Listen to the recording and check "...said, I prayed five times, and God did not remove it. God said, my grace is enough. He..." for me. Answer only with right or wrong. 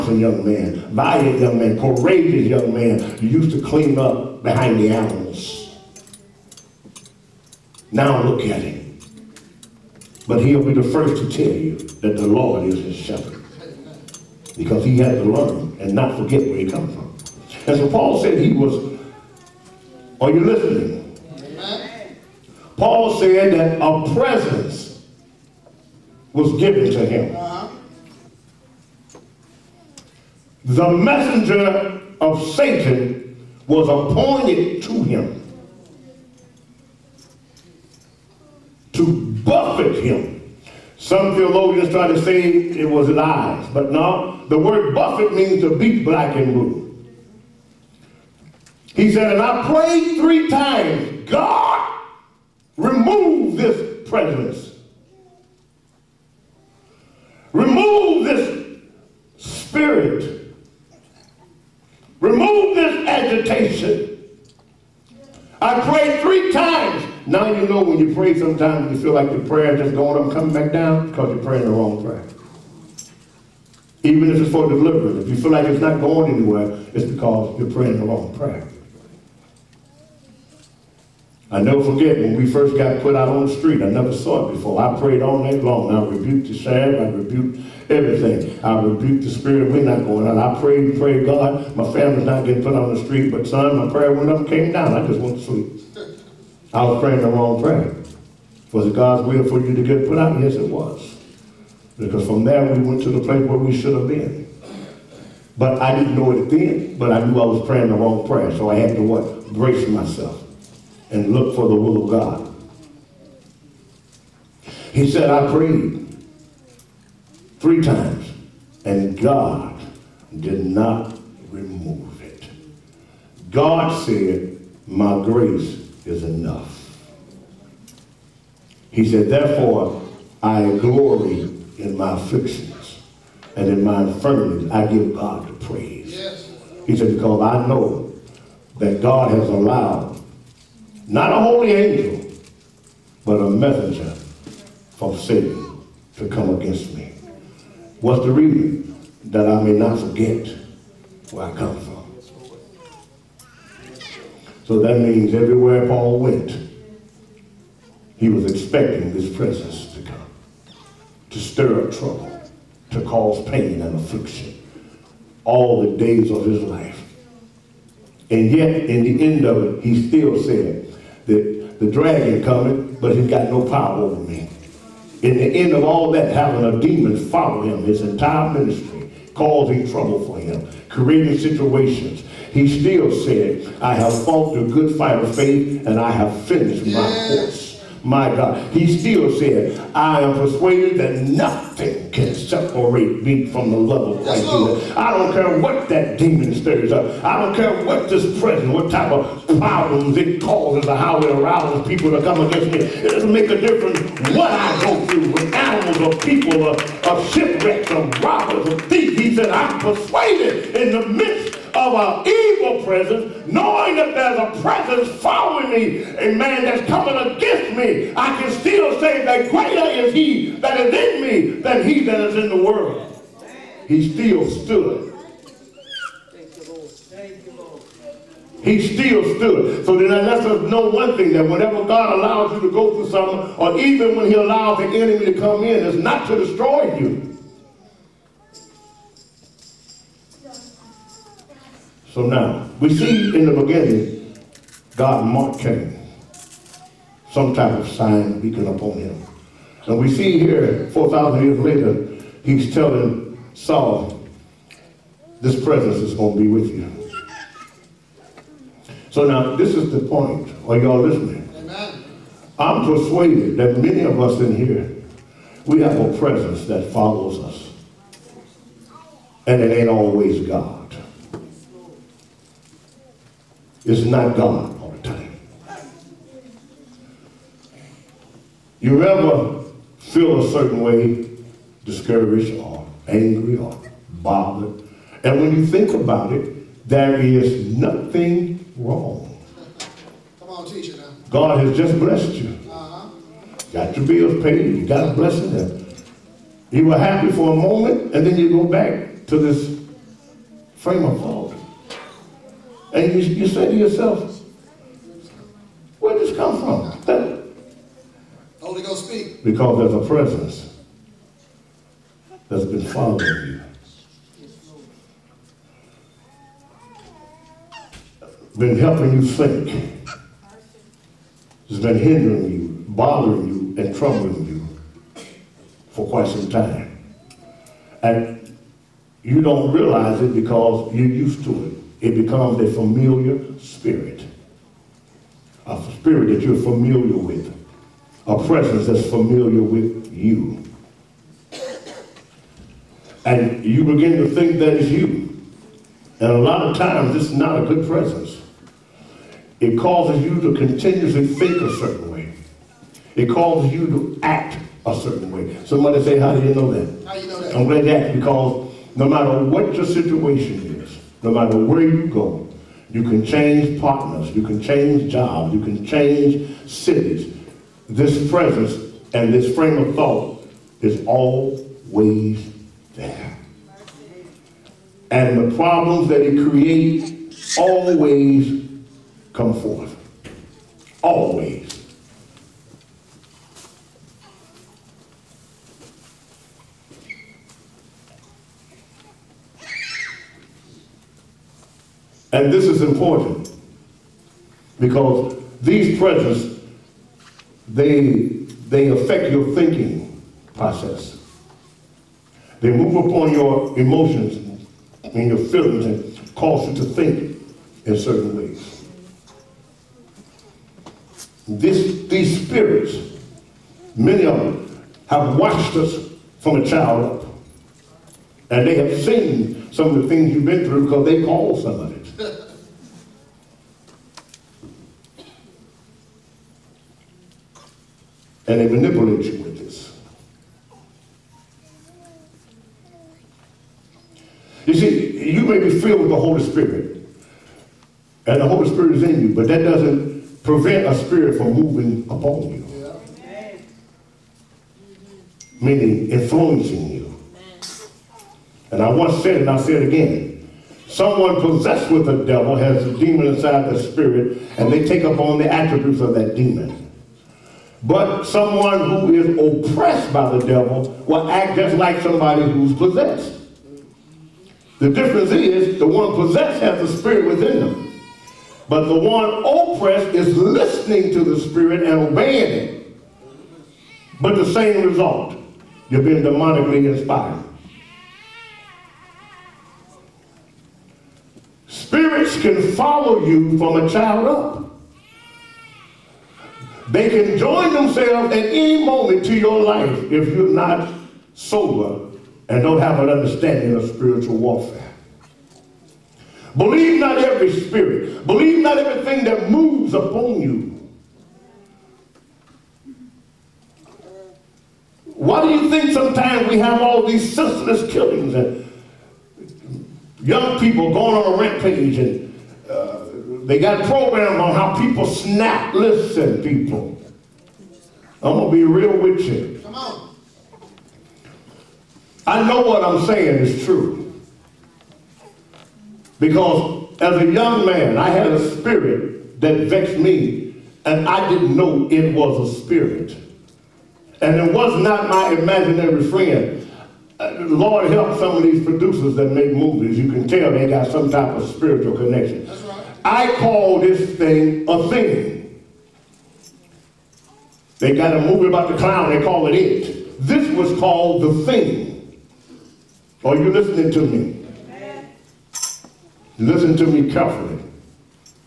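wrong.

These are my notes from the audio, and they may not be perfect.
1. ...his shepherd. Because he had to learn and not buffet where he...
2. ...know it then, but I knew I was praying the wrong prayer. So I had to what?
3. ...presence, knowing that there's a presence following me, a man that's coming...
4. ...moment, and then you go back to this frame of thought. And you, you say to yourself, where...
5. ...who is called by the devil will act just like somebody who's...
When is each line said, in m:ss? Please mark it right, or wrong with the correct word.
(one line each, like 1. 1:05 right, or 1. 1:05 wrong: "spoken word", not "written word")
1. 0:12 wrong: "forget", not "buffet"
2. 1:46 right
3. 3:32 right
4. 4:57 right
5. 7:38 wrong: "oppressed", not "called".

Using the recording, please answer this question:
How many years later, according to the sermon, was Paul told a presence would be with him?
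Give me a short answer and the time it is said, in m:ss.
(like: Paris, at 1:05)
4,000, at 4:10.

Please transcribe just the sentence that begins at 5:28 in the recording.
And you don't realize it because you're used to it.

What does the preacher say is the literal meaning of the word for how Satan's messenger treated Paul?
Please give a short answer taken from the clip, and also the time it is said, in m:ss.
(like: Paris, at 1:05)
beat black and blue, at 0:45.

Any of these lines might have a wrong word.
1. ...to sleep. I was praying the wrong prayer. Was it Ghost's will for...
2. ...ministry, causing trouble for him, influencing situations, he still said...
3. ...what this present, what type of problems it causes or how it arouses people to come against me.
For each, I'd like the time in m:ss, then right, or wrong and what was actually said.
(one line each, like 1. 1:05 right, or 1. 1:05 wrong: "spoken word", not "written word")
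1. 1:35 wrong: "God", not "Ghost"
2. 2:58 wrong: "creating", not "influencing"
3. 3:17 right.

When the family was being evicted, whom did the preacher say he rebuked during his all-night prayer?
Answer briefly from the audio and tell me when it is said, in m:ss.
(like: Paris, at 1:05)
the sheriff, at 1:26.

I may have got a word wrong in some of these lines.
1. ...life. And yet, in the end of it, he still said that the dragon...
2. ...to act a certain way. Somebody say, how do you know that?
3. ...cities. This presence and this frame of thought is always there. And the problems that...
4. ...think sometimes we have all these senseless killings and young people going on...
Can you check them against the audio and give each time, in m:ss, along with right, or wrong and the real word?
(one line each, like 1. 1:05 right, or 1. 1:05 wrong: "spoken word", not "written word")
1. 2:46 right
2. 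5:53 right
3. 6:06 right
4. 8:25 right.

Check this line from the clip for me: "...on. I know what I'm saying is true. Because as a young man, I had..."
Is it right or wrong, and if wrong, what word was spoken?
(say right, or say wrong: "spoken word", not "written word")
right.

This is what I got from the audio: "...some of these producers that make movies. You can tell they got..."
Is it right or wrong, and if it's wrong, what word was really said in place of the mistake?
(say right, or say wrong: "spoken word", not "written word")
right.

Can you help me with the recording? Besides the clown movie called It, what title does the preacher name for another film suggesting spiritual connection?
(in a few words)
The Thing.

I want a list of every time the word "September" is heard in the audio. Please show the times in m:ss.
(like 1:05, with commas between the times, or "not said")
not said.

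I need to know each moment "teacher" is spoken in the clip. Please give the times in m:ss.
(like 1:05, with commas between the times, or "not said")
4:50.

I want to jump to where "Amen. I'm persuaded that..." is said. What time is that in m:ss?
4:21.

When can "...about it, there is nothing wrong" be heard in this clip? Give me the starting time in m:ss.
4:45.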